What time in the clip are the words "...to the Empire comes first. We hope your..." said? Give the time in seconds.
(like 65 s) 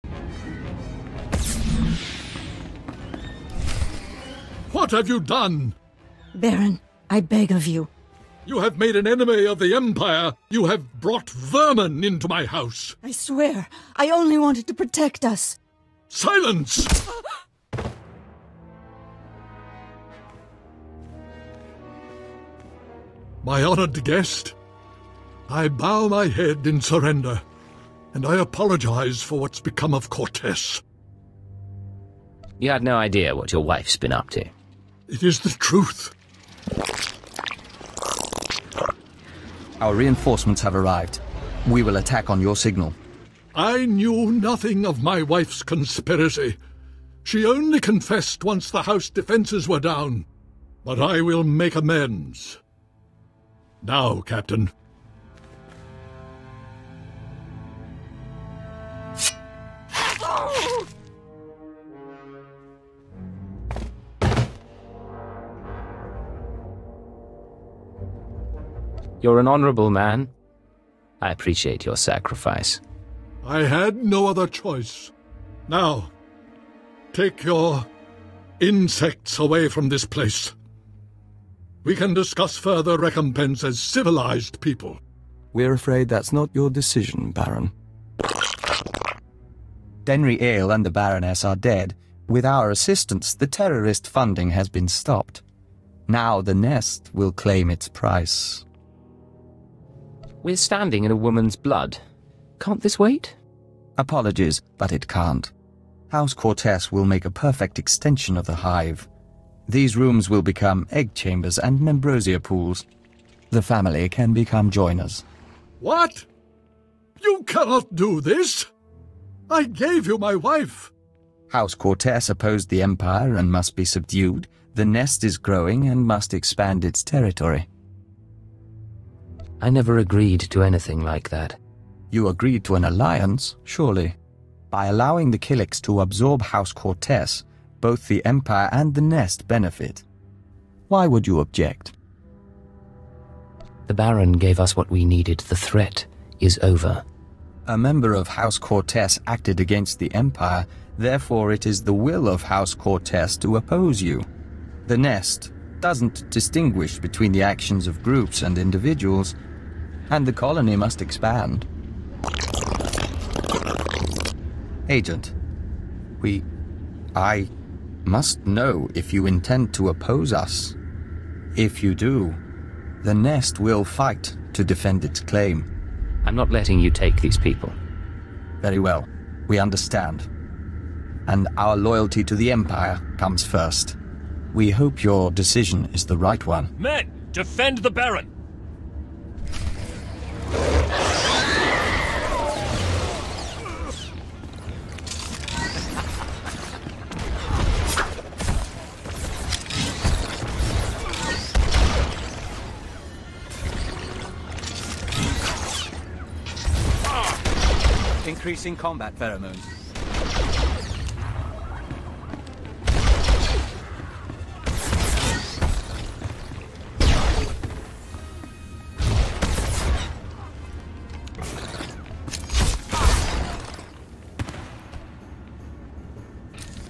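182 s.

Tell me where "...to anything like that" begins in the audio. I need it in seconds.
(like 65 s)
130 s.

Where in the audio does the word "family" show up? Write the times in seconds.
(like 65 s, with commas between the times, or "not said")
113 s.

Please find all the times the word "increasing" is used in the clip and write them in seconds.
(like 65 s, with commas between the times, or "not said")
208 s.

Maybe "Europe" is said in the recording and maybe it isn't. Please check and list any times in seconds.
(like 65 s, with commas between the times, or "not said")
not said.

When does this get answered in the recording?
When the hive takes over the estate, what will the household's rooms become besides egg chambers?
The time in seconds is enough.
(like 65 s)
111 s.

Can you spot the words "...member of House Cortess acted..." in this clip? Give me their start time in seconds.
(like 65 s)
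147 s.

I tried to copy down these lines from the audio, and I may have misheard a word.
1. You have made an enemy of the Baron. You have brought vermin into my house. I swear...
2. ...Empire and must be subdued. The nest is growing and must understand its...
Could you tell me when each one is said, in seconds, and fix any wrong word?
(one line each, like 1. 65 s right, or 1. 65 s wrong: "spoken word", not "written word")
1. 8 s wrong: "Empire", not "Baron"
2. 122 s wrong: "expand", not "understand".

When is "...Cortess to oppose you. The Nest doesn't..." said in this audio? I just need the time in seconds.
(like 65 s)
152 s.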